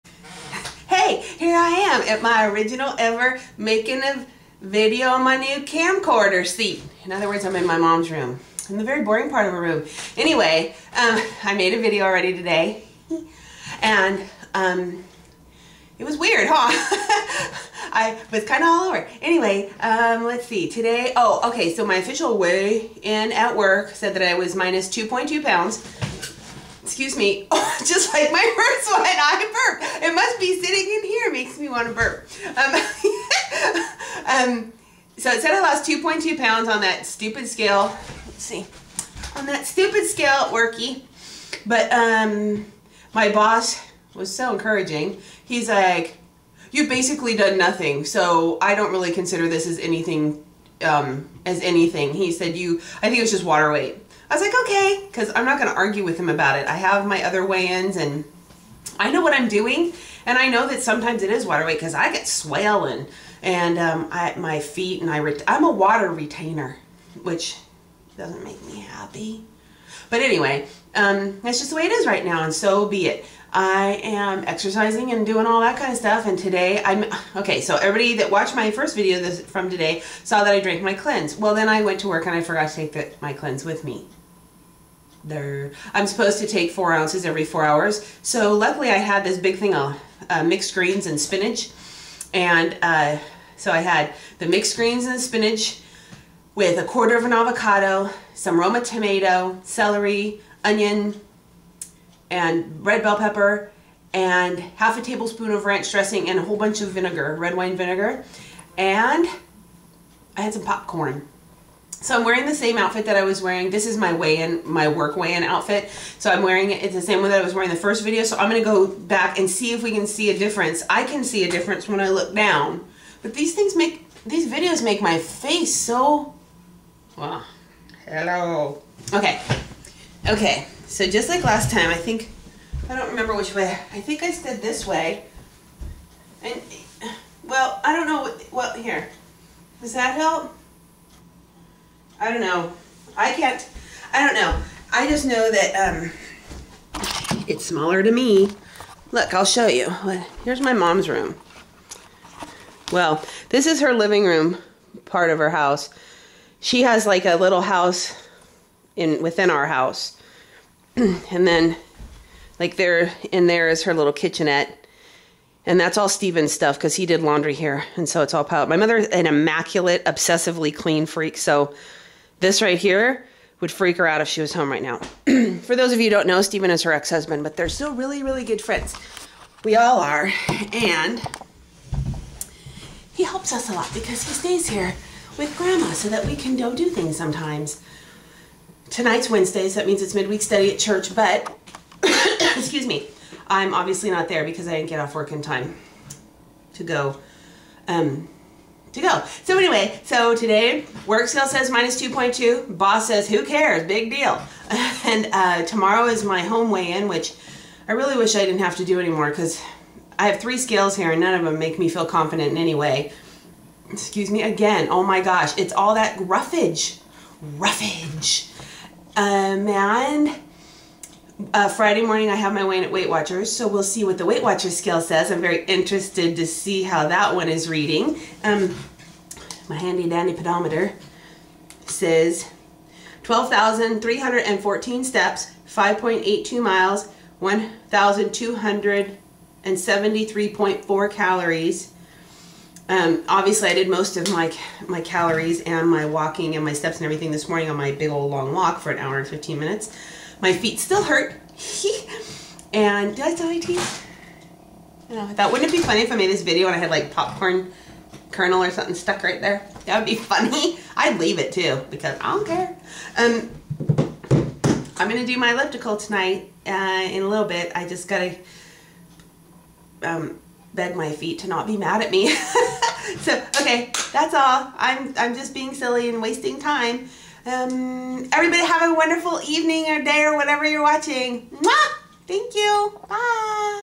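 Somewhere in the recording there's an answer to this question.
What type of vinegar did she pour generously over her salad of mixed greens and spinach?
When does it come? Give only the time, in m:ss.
1:47.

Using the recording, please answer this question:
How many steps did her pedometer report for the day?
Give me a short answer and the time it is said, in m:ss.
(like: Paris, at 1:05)
12,314, at 3:53.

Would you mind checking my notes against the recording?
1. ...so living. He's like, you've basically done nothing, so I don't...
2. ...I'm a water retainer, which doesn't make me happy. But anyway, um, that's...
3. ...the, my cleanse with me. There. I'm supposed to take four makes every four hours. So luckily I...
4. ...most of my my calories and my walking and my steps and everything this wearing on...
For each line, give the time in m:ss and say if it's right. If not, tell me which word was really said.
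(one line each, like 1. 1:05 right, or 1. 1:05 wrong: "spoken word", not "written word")
1. 0:44 wrong: "encouraging", not "living"
2. 1:05 right
3. 1:22 wrong: "ounces", not "makes"
4. 4:03 wrong: "morning", not "wearing".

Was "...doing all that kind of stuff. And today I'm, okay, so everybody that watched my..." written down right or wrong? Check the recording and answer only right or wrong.
right.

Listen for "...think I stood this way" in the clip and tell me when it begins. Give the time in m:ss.
2:14.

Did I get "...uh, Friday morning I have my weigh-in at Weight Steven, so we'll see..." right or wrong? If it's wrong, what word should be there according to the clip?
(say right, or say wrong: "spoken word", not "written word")
wrong: "Watchers", not "Steven".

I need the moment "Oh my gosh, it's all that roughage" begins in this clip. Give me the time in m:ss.
3:34.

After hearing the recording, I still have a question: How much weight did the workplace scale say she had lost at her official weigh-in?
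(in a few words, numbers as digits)
2.2 pounds.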